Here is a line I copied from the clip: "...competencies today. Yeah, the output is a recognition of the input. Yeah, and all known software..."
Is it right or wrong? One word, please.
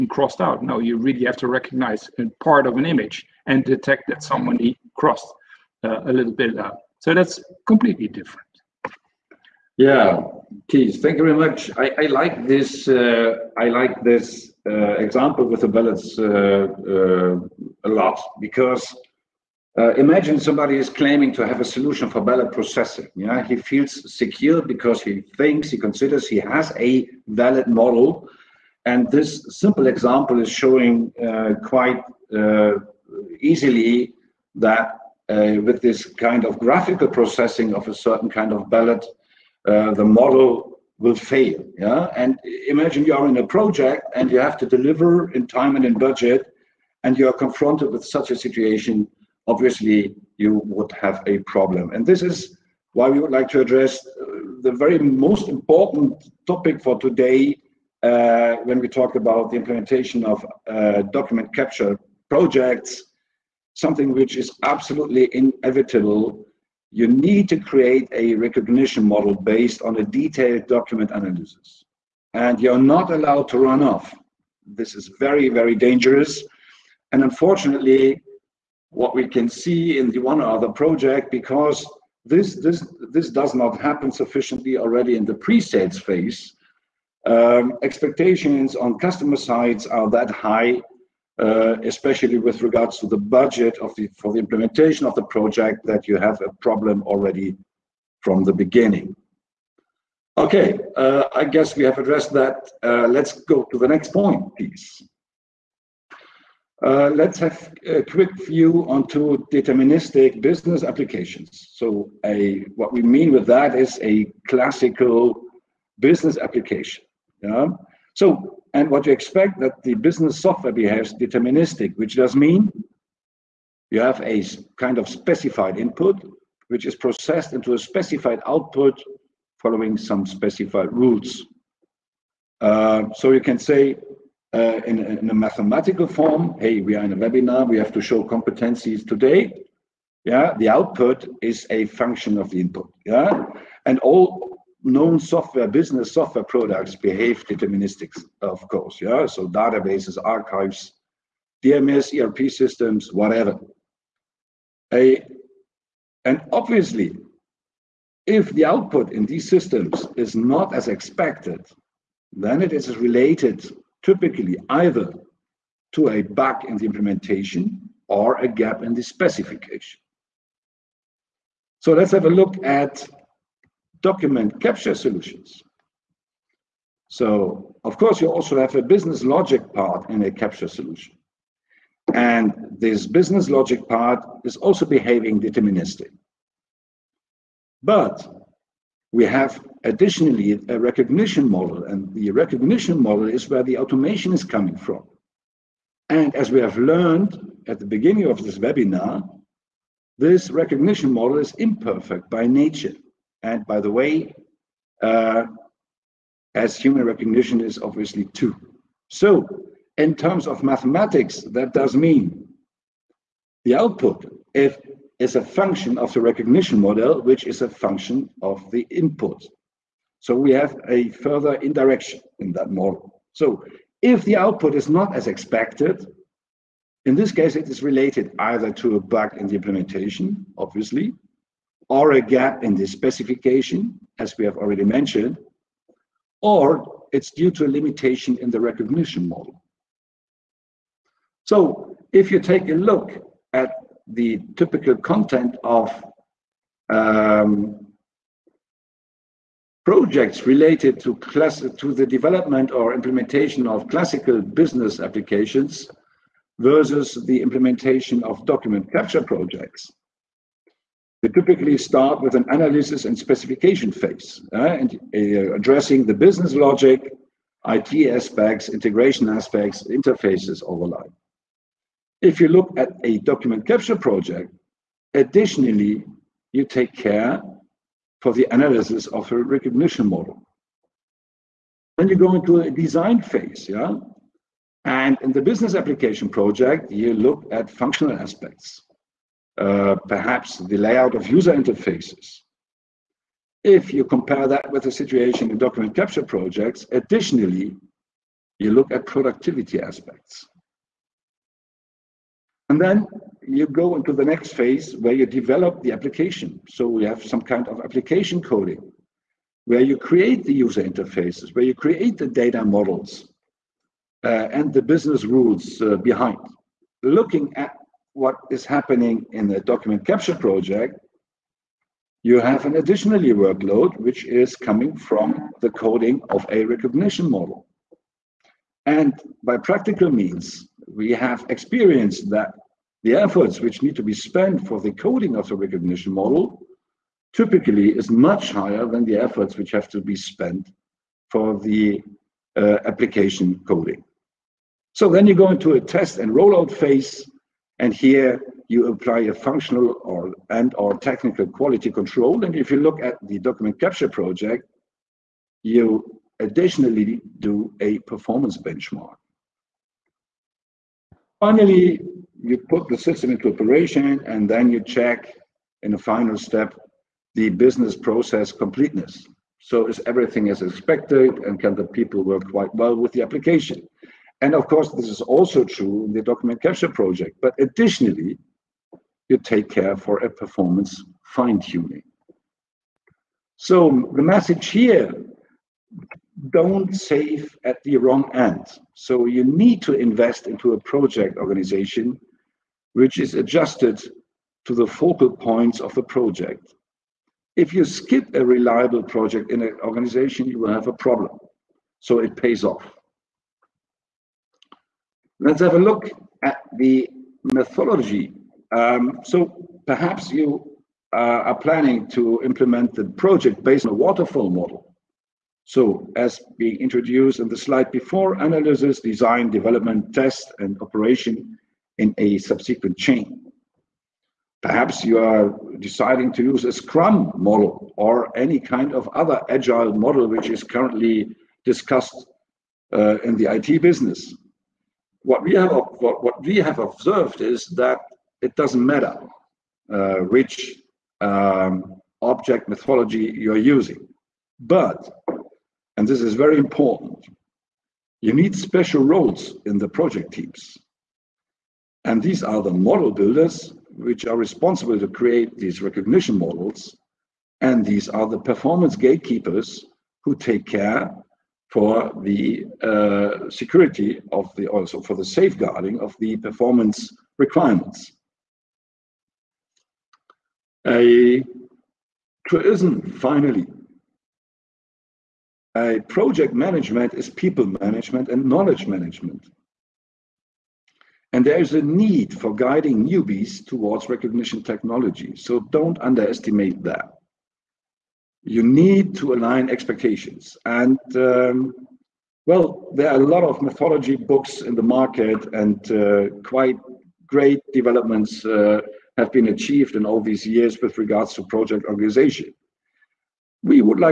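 wrong.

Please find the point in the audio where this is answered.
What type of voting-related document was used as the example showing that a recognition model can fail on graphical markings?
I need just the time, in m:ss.
0:15.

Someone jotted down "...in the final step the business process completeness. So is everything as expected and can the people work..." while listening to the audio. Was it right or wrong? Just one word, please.
right.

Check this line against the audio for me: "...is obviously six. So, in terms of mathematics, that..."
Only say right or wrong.
wrong.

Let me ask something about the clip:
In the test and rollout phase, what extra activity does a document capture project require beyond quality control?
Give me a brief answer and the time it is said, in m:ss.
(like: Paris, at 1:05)
Performance benchmark, at 5:57.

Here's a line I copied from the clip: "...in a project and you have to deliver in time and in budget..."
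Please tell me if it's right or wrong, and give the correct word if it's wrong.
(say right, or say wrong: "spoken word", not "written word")
right.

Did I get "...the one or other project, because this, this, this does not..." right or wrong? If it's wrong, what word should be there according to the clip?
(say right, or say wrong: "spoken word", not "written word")
right.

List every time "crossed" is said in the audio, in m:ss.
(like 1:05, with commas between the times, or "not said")
0:00, 0:04.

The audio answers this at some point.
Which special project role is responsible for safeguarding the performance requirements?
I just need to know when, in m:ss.
7:38.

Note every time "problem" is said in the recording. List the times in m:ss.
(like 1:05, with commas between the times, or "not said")
0:51, 1:36, 6:40.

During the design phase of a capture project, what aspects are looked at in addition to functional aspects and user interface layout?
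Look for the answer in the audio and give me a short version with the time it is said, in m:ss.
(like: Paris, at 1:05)
Productivity aspects, at 4:59.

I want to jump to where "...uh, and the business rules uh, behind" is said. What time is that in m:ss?
5:14.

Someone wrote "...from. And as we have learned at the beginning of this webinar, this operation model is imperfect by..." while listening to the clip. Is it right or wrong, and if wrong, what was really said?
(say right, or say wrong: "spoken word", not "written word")
wrong: "recognition", not "operation".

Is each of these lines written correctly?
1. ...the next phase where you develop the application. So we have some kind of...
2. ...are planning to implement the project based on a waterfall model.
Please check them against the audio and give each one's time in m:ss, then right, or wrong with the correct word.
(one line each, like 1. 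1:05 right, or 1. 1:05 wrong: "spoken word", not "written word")
1. 5:04 right
2. 6:51 right.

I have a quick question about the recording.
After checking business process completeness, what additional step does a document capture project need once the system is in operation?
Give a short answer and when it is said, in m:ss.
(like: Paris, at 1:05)
Performance fine tuning, at 6:20.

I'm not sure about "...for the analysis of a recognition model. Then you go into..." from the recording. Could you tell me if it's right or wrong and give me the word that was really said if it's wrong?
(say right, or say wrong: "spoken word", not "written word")
right.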